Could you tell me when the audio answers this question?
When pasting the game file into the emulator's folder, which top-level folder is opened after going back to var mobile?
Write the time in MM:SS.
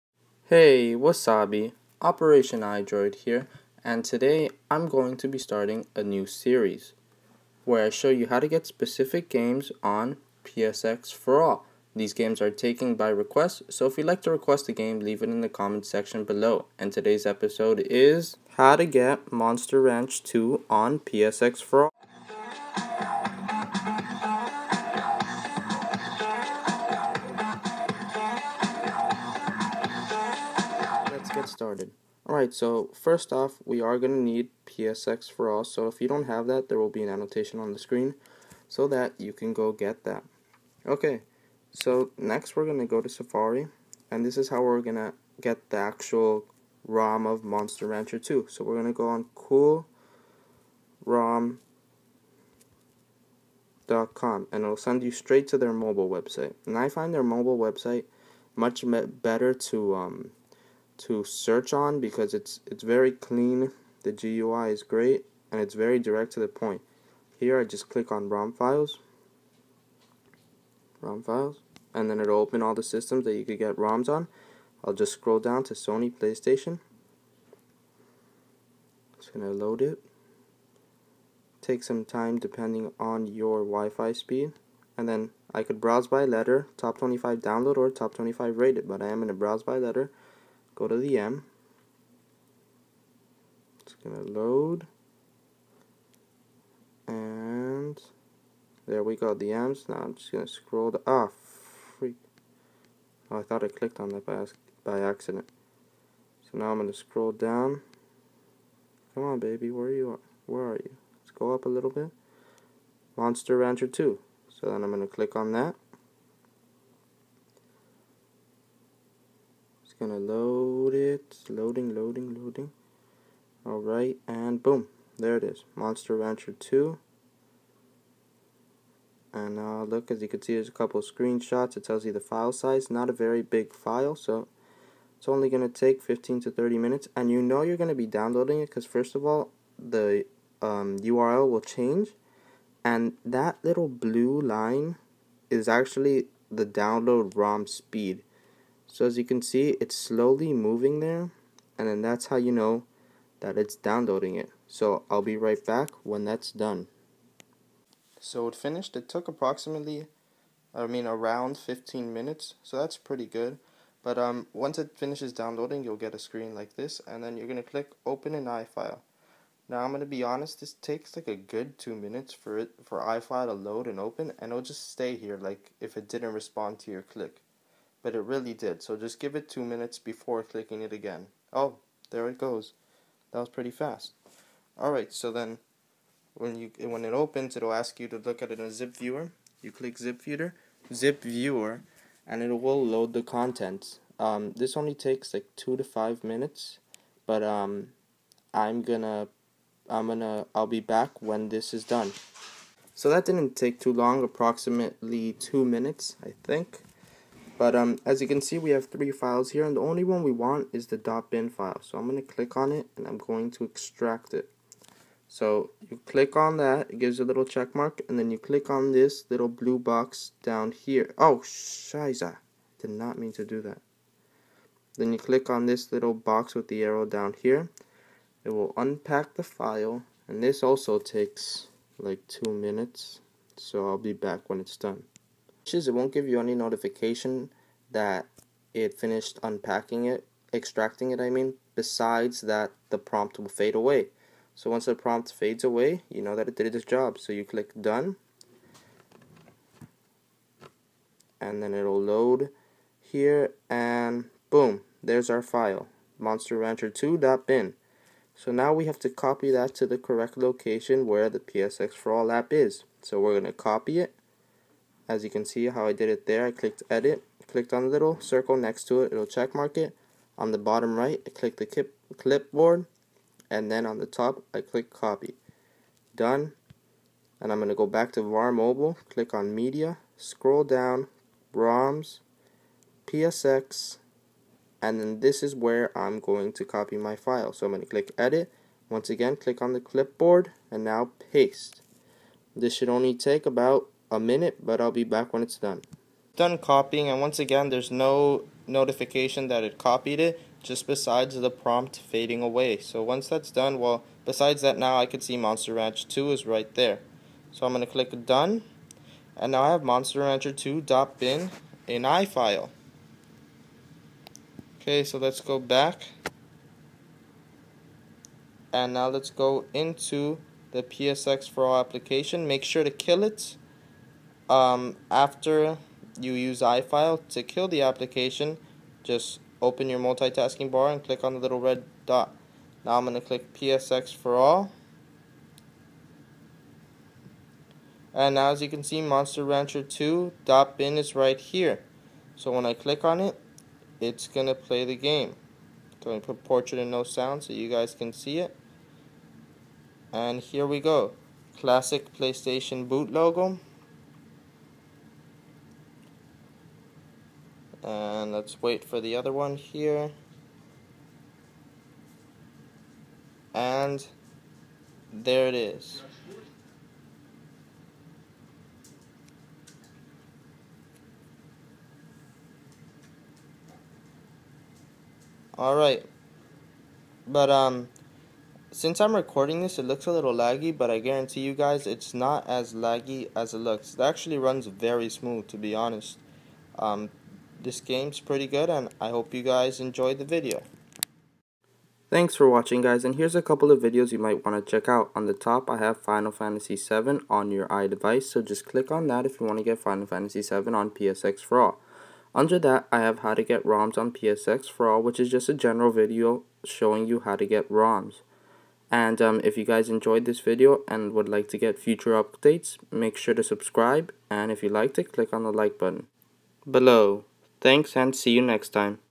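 04:39.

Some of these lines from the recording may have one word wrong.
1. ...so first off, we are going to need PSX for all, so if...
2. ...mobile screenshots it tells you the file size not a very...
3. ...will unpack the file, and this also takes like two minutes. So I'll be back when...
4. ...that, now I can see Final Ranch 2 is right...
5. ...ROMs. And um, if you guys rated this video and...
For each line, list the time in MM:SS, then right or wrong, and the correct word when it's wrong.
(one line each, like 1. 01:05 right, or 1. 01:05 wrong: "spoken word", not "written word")
1. 00:32 right
2. 02:10 wrong: "couple", not "mobile"
3. 03:48 right
4. 05:04 wrong: "Monster", not "Final"
5. 06:47 wrong: "enjoyed", not "rated".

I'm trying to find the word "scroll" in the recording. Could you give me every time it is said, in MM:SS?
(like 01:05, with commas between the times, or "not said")
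01:15, 01:40, 01:46, 04:40.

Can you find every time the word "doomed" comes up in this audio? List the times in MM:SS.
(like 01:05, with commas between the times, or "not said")
not said.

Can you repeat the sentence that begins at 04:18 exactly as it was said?
So now we have to copy that to the correct location where the PSX for all app is.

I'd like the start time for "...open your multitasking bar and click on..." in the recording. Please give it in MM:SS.
05:29.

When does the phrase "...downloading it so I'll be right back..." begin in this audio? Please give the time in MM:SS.
02:33.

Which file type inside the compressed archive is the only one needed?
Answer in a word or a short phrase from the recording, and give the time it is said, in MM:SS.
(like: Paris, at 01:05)
.bin, at 03:31.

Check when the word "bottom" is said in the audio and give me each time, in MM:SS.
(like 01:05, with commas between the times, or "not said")
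04:30.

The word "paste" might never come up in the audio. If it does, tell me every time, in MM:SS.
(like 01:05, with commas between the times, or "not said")
04:51.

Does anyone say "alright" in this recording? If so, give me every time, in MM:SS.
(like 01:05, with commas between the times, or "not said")
00:32, 02:03, 03:04, 06:15.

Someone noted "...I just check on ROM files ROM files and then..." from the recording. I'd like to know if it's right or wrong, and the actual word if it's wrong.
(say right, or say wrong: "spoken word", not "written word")
wrong: "click", not "check".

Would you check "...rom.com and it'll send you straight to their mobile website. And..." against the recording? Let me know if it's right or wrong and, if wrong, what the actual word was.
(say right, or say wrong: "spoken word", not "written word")
right.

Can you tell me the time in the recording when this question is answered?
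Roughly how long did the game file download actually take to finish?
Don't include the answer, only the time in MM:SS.
02:41.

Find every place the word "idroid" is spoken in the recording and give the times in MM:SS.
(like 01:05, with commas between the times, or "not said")
00:02.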